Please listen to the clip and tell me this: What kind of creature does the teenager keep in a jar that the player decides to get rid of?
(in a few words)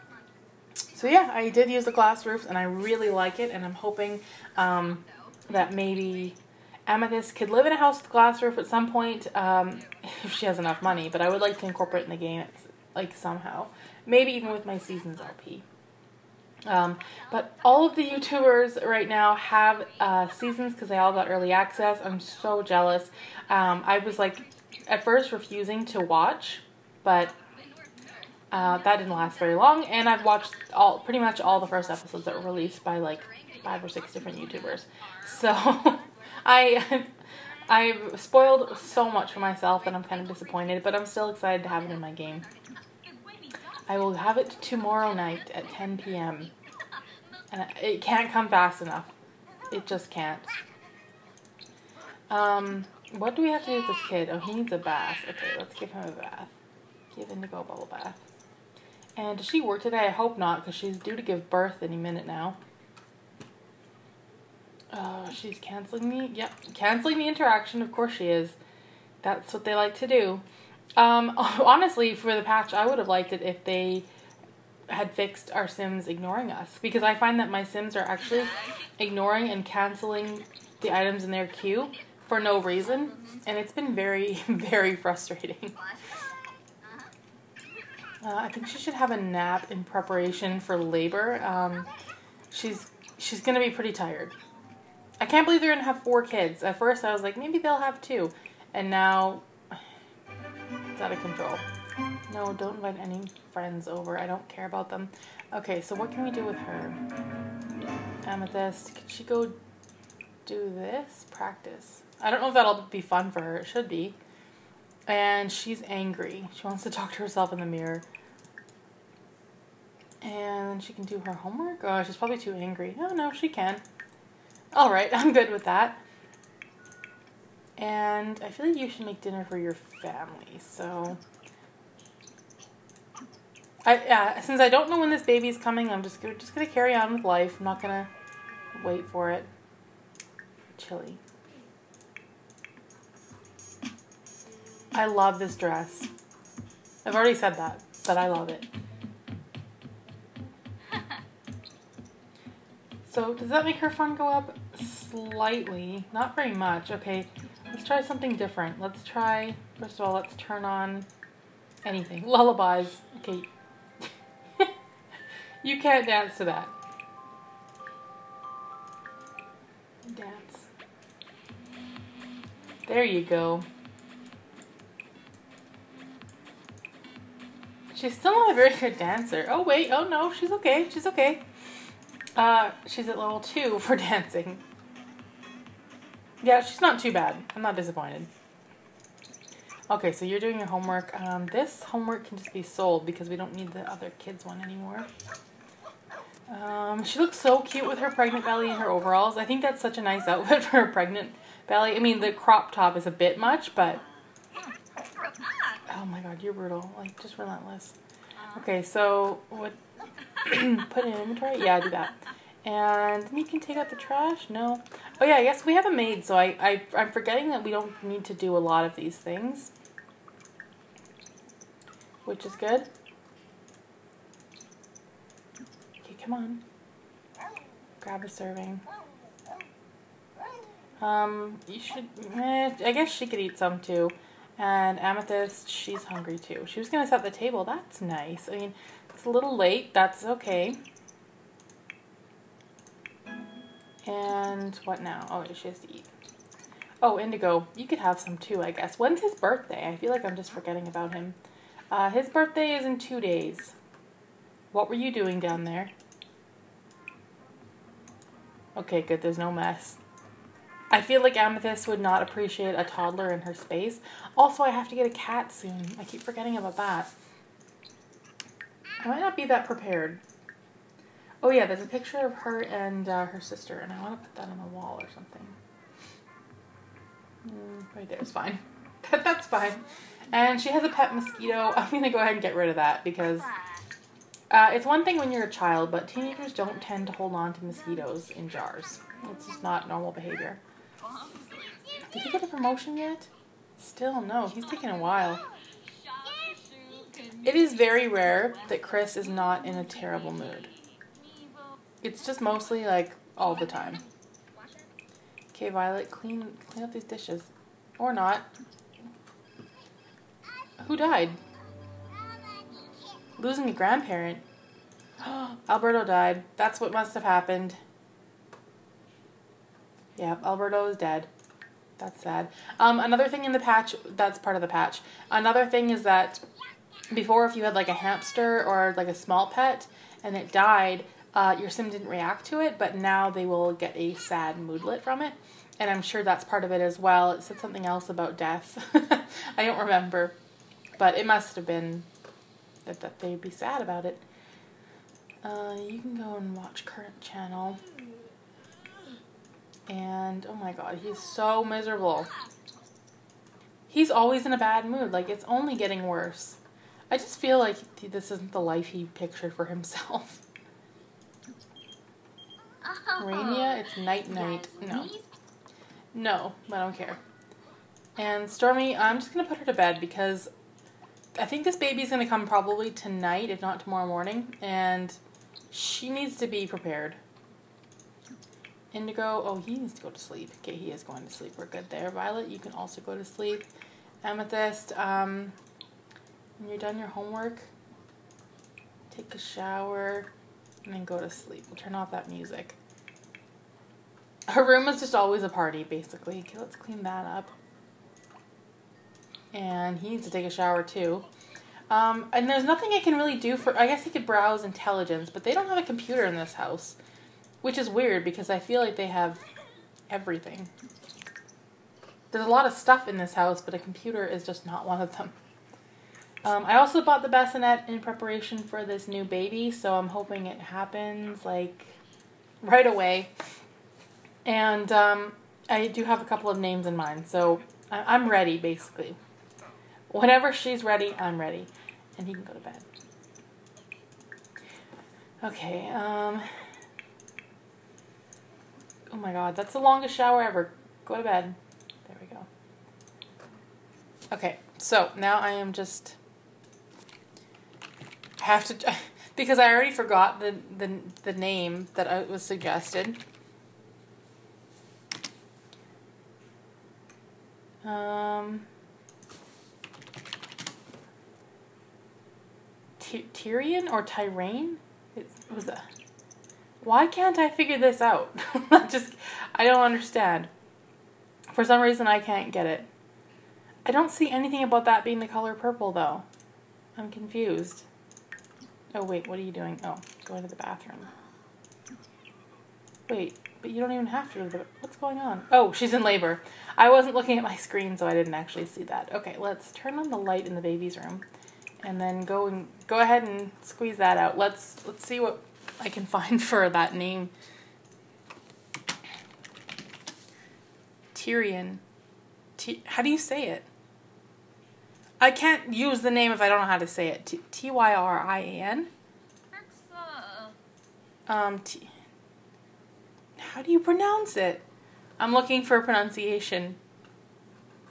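mosquito.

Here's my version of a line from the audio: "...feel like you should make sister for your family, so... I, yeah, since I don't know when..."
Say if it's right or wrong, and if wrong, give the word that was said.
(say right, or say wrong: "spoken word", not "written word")
wrong: "dinner", not "sister".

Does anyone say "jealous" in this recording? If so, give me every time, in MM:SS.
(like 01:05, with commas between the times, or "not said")
00:22.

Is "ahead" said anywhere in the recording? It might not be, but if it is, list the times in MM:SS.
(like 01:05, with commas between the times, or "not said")
04:42, 08:12.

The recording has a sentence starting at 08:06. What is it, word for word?
I wasn't looking at my screen, so I didn't actually see that.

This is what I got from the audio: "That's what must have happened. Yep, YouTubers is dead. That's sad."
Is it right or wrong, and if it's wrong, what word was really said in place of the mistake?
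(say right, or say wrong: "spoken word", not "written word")
wrong: "Alberto", not "YouTubers".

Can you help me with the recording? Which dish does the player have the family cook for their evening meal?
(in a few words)
Chili.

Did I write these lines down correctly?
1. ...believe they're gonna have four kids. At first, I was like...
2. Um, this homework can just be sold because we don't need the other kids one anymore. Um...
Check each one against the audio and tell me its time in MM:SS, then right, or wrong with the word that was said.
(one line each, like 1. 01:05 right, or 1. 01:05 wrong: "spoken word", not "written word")
1. 01:35 right
2. 03:11 right.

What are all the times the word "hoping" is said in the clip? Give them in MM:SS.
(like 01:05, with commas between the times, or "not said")
00:03, 07:00.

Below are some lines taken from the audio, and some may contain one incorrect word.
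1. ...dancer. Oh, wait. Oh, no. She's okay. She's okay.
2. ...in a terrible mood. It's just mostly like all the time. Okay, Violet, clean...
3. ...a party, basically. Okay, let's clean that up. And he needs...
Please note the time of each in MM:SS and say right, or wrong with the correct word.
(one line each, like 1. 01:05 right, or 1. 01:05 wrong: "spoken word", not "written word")
1. 02:58 right
2. 04:59 right
3. 06:35 right.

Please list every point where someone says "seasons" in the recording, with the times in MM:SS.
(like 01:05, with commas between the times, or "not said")
00:14, 00:20.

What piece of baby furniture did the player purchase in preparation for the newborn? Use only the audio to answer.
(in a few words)
bassinet.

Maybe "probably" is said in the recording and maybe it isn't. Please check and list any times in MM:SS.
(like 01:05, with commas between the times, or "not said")
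02:02, 06:12.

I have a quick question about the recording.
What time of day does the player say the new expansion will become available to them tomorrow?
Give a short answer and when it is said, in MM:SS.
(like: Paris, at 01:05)
10 p.m., at 00:45.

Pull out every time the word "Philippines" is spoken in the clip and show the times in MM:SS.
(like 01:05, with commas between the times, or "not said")
not said.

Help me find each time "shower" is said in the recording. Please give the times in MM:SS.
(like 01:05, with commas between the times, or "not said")
06:29, 06:40, 07:20.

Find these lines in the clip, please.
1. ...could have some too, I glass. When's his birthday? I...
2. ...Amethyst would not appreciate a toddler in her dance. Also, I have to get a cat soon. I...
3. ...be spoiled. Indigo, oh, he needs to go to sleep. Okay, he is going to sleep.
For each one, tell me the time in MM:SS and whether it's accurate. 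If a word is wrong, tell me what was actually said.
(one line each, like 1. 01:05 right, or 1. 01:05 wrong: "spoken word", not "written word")
1. 04:07 wrong: "guess", not "glass"
2. 04:21 wrong: "space", not "dance"
3. 06:16 wrong: "prepared", not "spoiled".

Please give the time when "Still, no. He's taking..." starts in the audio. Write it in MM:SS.
04:53.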